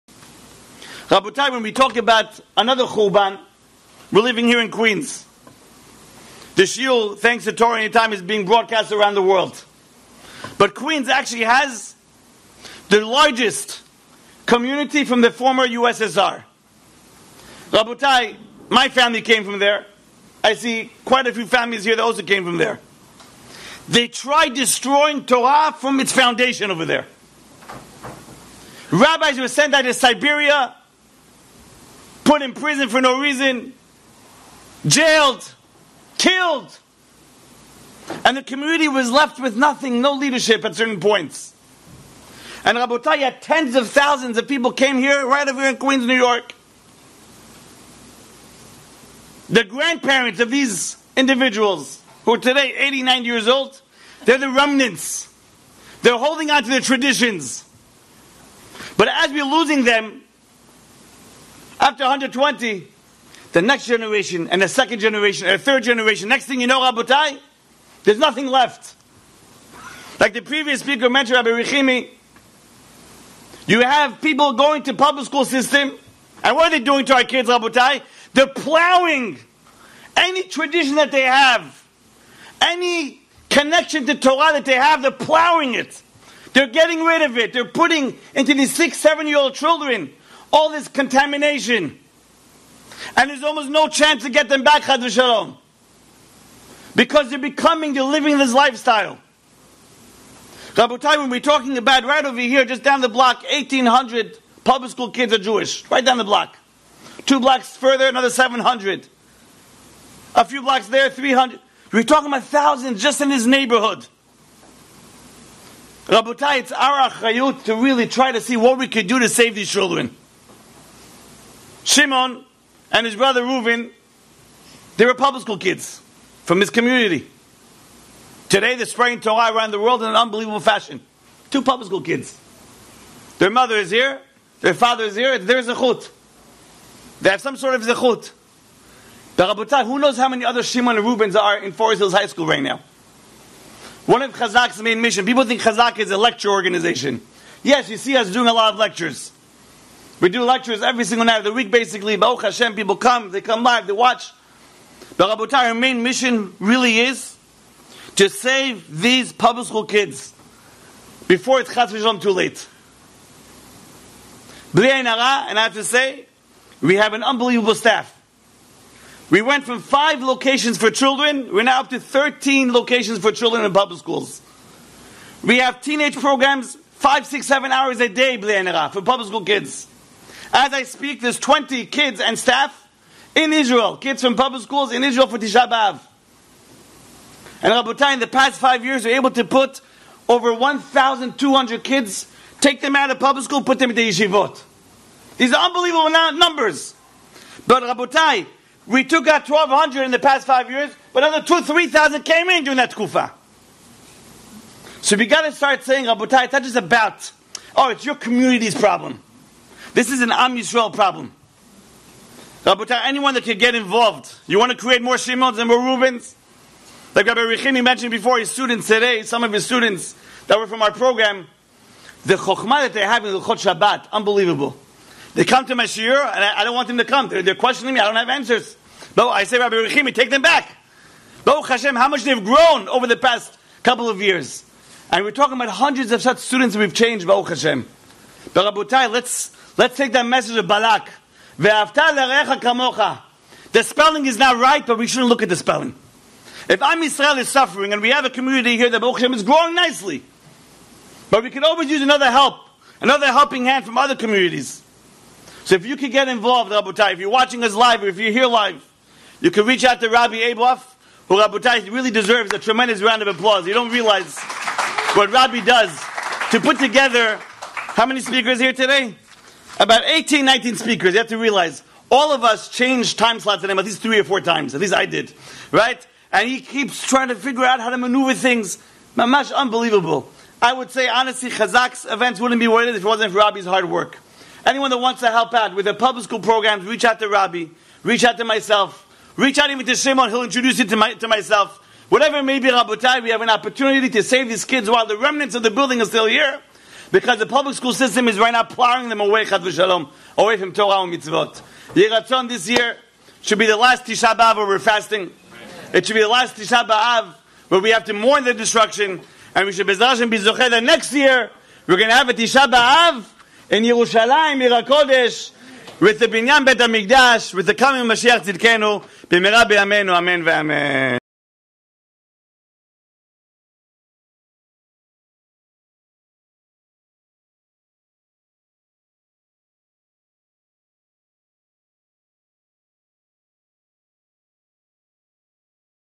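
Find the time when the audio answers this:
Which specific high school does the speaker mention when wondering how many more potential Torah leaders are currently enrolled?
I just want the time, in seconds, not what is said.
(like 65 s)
141 s.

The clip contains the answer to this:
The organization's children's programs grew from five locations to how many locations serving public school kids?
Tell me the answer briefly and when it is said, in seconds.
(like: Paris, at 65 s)
13, at 171 s.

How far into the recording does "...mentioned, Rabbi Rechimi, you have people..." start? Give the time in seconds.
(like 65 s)
71 s.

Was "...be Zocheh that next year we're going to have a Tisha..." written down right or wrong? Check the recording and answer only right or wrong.
right.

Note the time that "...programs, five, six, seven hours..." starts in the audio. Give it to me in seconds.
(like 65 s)
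176 s.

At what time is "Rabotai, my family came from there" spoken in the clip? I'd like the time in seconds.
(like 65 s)
17 s.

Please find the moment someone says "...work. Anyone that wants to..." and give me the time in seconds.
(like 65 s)
283 s.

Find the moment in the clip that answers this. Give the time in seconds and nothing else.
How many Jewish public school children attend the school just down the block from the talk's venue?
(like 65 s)
103 s.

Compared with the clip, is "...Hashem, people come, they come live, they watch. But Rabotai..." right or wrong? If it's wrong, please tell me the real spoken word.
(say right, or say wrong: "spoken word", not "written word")
right.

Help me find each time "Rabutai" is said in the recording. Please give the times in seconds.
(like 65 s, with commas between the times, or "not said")
187 s, 197 s, 206 s, 238 s, 256 s, 261 s.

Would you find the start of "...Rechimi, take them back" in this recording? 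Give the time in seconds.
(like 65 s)
229 s.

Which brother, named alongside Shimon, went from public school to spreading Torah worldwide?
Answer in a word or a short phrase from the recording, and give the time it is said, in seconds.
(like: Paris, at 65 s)
Reuven, at 123 s.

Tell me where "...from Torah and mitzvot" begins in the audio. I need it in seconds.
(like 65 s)
300 s.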